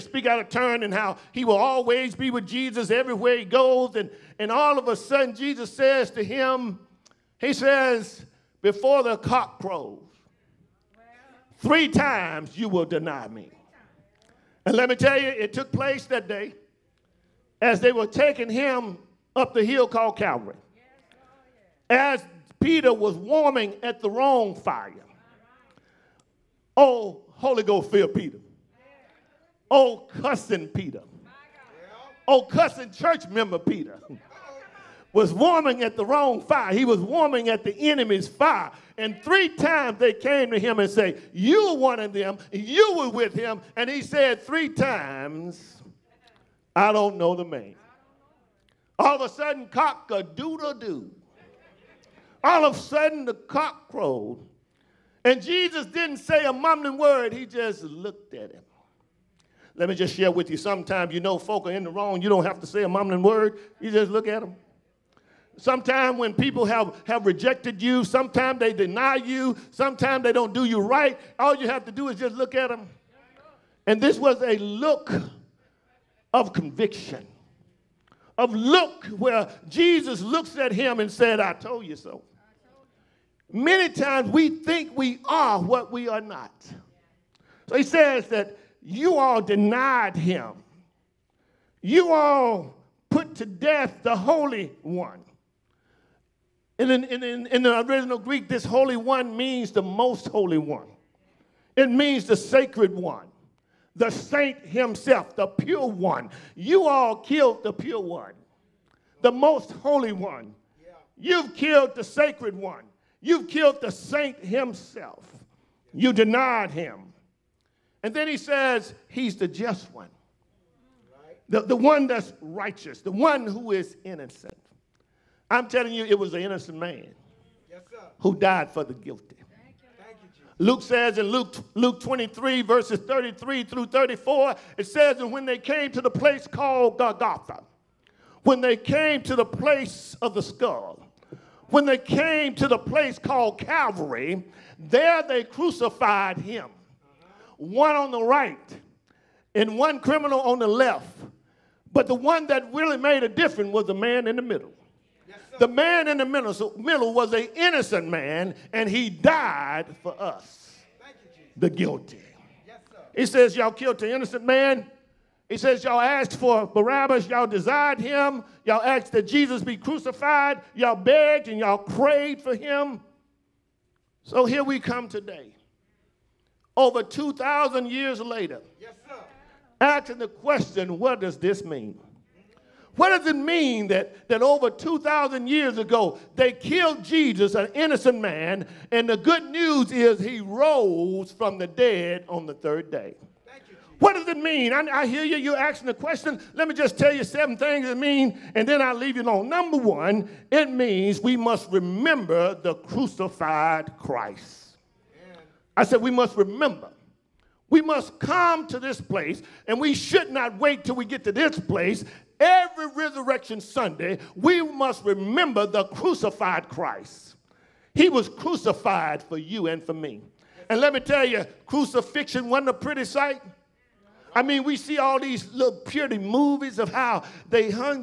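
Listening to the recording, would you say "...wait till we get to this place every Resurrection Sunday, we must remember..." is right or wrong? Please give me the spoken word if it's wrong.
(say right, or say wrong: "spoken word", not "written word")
right.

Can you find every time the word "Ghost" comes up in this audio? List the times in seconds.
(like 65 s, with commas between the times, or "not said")
27 s.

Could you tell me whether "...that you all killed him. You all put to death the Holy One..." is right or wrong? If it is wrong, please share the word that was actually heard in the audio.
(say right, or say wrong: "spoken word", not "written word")
wrong: "denied", not "killed".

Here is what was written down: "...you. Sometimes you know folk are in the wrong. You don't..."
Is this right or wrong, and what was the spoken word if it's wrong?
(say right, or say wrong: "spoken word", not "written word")
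right.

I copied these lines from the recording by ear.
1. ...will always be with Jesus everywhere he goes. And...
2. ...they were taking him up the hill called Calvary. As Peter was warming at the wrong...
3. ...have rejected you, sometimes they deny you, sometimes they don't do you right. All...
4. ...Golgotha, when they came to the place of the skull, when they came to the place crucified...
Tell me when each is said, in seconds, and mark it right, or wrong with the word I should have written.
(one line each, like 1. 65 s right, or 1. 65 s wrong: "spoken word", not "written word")
1. 1 s right
2. 17 s right
3. 67 s right
4. 136 s wrong: "called", not "crucified".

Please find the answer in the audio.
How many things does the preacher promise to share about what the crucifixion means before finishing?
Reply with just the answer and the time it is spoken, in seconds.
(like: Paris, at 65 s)
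7, at 197 s.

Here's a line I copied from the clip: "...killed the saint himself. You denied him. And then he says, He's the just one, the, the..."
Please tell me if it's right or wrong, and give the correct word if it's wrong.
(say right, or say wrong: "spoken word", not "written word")
right.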